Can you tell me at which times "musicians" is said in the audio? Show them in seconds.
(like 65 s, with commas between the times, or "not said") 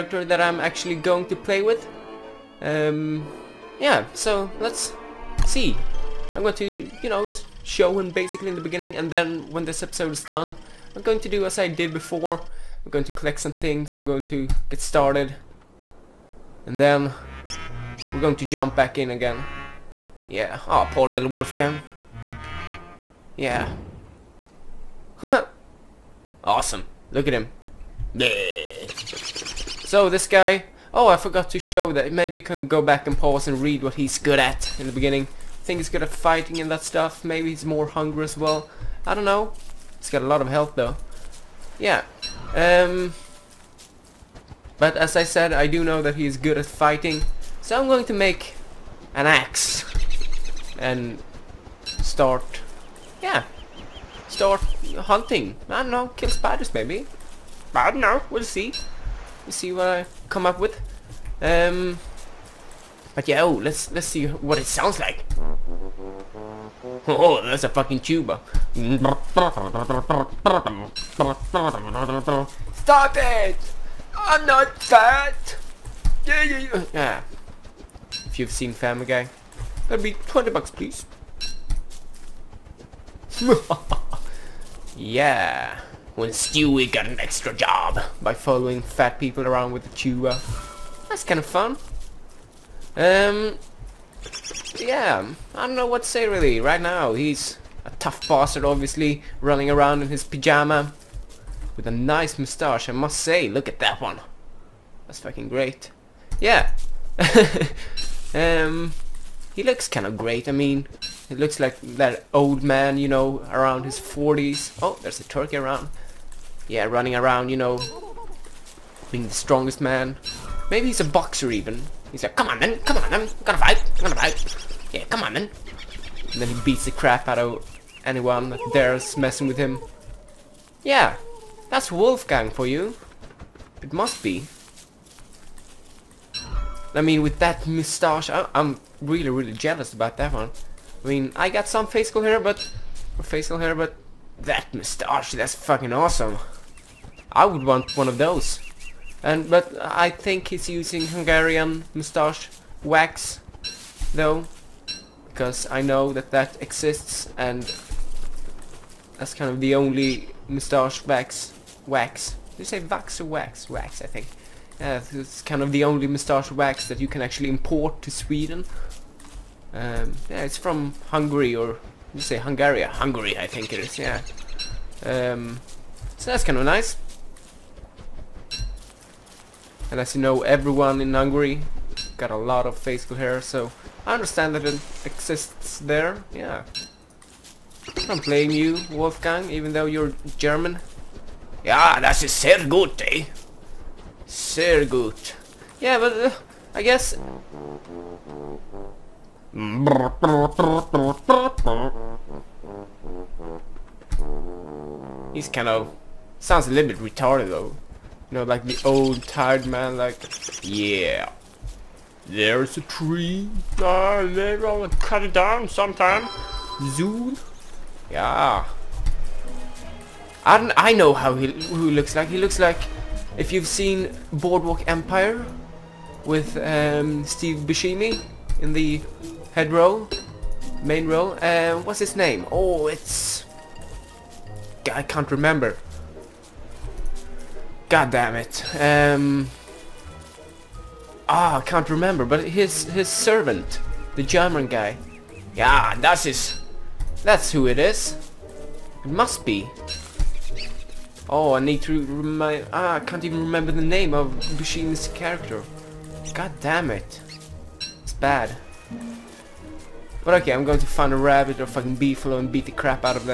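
not said.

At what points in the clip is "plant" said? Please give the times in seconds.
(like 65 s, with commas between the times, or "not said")
not said.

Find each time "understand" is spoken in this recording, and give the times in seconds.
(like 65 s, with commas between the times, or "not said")
184 s.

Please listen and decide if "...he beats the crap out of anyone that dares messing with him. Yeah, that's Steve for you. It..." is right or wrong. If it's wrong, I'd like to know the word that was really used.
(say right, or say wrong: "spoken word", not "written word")
wrong: "Wolfgang", not "Steve".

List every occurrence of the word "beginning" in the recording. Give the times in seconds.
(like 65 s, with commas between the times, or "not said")
8 s, 34 s.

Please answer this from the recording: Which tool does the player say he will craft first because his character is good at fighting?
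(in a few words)
An axe.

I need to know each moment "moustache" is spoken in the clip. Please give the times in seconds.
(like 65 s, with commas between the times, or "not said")
102 s, 137 s.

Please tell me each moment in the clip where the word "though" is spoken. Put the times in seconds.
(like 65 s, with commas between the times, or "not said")
40 s, 154 s, 189 s, 207 s.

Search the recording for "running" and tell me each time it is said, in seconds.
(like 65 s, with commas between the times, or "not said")
99 s, 116 s.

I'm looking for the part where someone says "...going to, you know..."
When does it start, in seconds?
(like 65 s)
6 s.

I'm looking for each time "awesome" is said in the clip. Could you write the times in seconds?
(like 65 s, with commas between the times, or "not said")
26 s, 145 s.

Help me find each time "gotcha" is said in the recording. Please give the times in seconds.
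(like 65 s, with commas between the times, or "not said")
not said.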